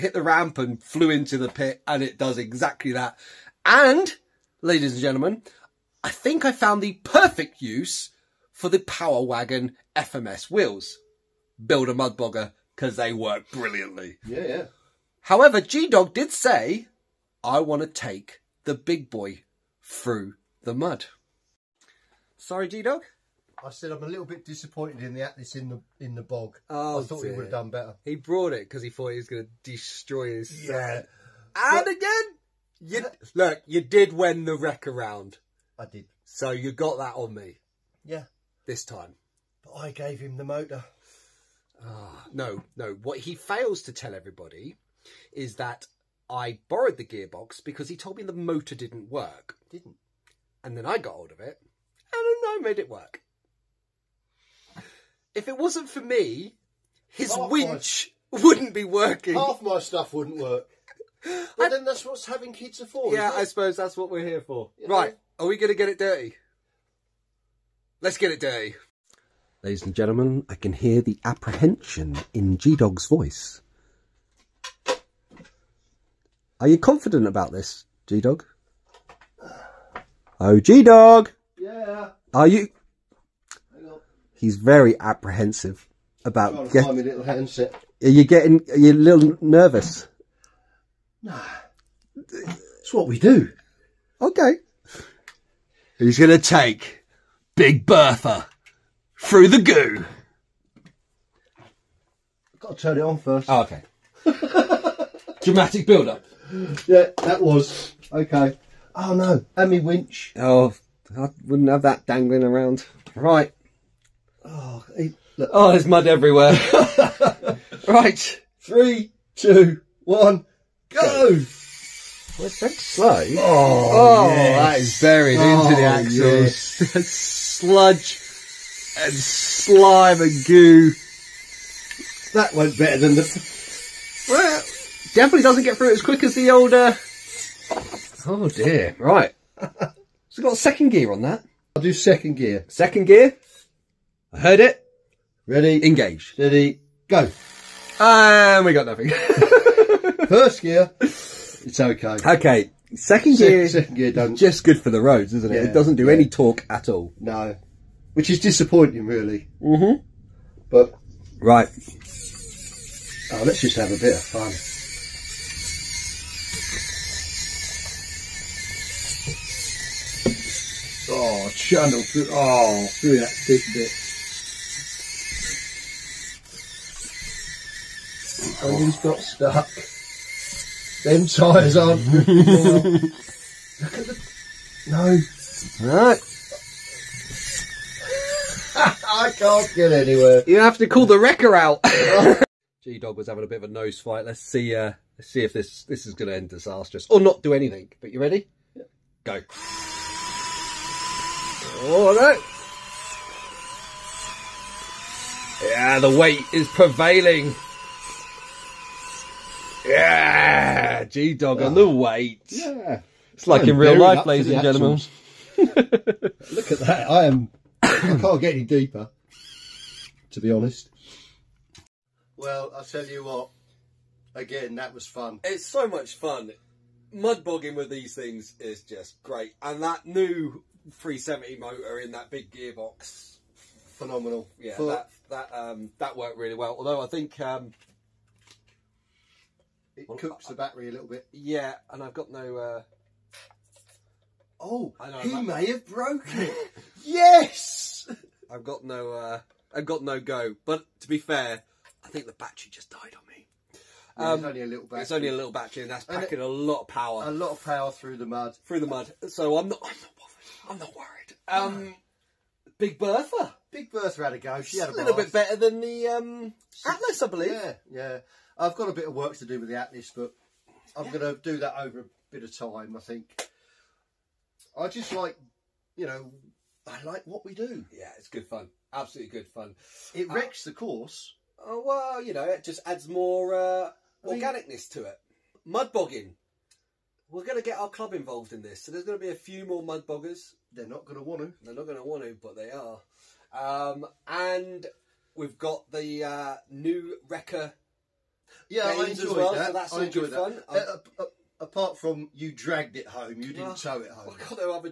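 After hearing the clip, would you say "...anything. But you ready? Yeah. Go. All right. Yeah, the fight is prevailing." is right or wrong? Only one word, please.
wrong.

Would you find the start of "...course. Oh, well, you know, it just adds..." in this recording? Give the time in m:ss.
4:40.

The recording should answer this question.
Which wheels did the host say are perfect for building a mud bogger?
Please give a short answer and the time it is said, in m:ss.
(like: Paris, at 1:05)
Power Wagon FMS, at 0:08.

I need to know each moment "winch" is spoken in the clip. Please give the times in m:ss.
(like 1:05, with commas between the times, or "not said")
0:57, 1:49.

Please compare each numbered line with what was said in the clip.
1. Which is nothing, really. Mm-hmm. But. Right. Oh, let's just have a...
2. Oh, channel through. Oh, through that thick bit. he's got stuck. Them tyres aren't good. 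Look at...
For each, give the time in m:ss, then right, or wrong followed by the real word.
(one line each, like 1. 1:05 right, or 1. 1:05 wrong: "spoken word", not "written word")
1. 2:38 wrong: "disappointing", not "nothing"
2. 2:51 right.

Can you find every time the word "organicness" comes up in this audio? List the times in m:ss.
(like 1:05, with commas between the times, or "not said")
4:44.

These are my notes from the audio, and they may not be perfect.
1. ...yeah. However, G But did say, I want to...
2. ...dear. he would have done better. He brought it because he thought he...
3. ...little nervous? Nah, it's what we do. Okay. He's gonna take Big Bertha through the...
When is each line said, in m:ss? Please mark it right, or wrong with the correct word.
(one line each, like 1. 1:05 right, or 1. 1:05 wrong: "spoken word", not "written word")
1. 0:14 wrong: "Dog", not "But"
2. 0:27 right
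3. 1:28 right.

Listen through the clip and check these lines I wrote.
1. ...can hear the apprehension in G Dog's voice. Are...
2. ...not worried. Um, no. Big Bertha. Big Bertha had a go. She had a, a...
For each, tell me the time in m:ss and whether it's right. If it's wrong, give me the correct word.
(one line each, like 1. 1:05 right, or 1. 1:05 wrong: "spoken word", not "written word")
1. 1:10 right
2. 4:20 right.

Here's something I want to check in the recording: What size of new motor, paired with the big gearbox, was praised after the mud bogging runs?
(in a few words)
370.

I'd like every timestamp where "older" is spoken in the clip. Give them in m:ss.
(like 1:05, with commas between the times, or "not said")
2:16.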